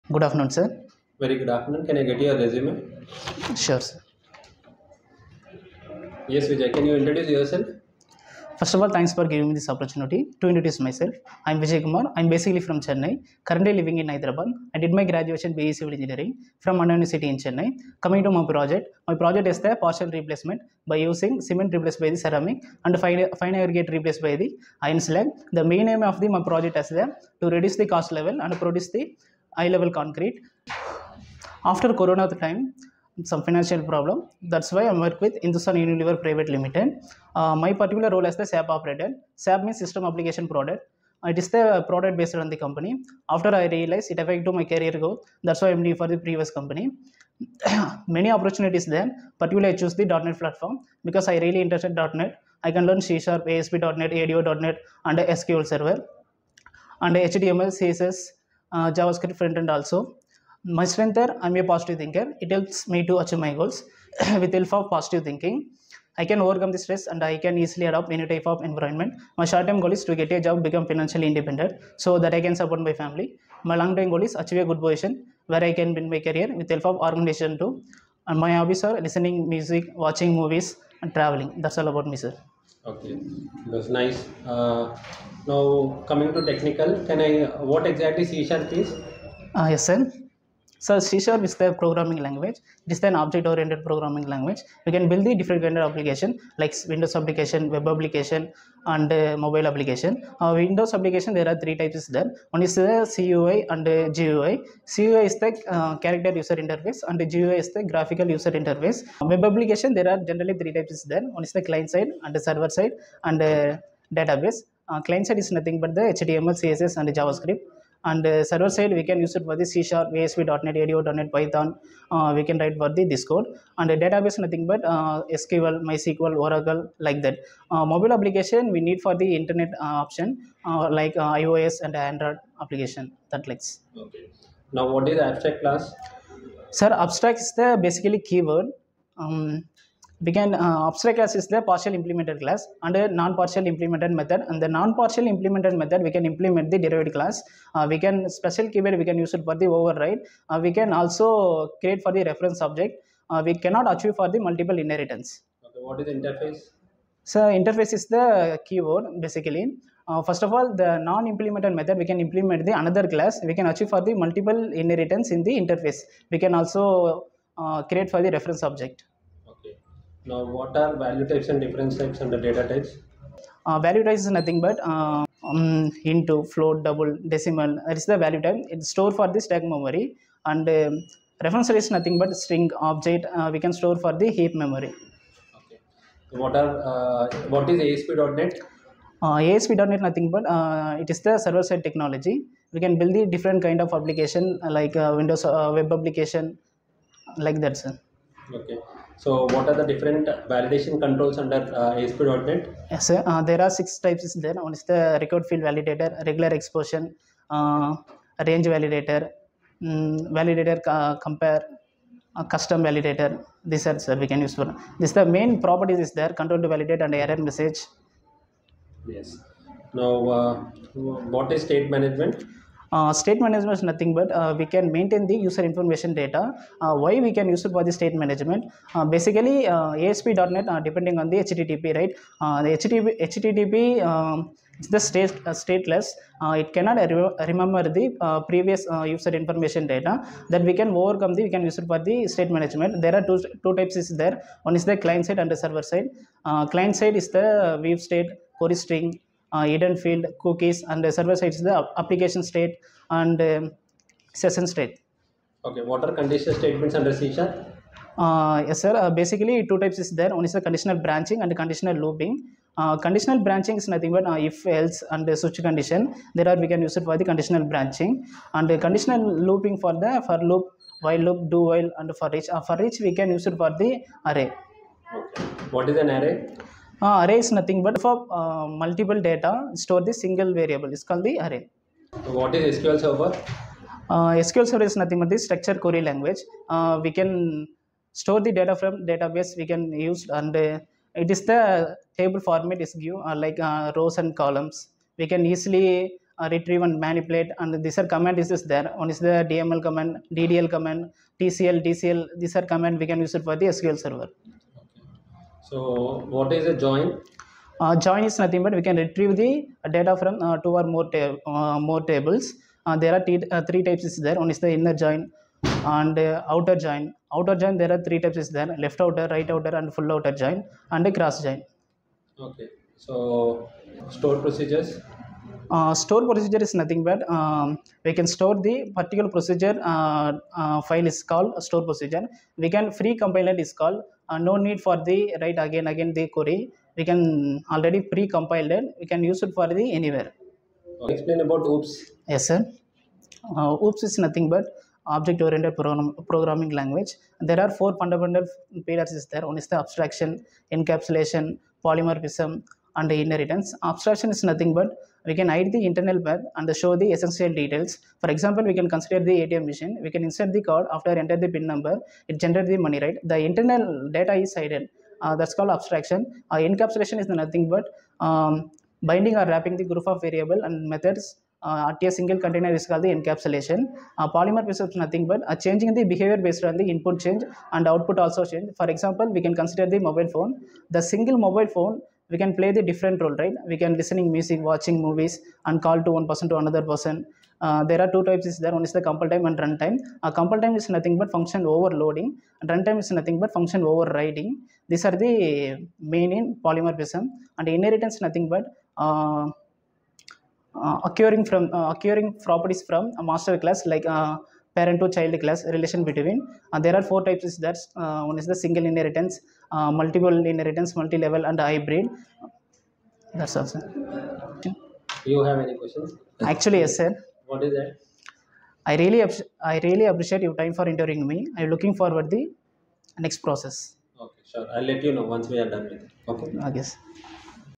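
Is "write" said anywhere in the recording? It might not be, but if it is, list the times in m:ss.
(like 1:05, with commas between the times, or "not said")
2:02, 5:35.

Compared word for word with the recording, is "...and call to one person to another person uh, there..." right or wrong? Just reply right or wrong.
right.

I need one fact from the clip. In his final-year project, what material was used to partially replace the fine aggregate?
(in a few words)
iron slag.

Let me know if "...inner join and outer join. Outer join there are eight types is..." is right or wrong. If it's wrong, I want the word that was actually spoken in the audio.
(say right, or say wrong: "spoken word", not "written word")
wrong: "three", not "eight".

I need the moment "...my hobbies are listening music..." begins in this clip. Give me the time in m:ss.
1:18.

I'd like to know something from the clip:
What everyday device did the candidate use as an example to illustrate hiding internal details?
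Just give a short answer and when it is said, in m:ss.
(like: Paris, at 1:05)
ATM machine, at 5:59.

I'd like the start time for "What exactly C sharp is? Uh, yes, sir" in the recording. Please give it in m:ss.
1:27.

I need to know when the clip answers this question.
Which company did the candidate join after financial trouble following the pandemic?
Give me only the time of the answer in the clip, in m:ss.
0:35.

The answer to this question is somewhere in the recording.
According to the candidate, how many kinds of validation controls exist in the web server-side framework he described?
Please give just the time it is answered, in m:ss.
3:23.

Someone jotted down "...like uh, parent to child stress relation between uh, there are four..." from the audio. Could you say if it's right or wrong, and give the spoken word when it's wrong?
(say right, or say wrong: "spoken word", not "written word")
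wrong: "class", not "stress".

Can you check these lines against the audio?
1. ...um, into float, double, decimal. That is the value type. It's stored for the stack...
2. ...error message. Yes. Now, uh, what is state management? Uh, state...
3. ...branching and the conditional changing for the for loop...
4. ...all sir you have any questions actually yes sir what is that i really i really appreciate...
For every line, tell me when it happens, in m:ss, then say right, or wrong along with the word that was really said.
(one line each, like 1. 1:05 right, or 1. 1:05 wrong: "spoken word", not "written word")
1. 2:55 right
2. 3:37 right
3. 4:27 wrong: "looping", not "changing"
4. 6:53 right.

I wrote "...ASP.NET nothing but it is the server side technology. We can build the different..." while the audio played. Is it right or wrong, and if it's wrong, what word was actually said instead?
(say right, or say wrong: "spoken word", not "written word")
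right.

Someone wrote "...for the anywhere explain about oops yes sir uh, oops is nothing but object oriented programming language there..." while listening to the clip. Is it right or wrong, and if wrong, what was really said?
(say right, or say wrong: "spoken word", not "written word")
right.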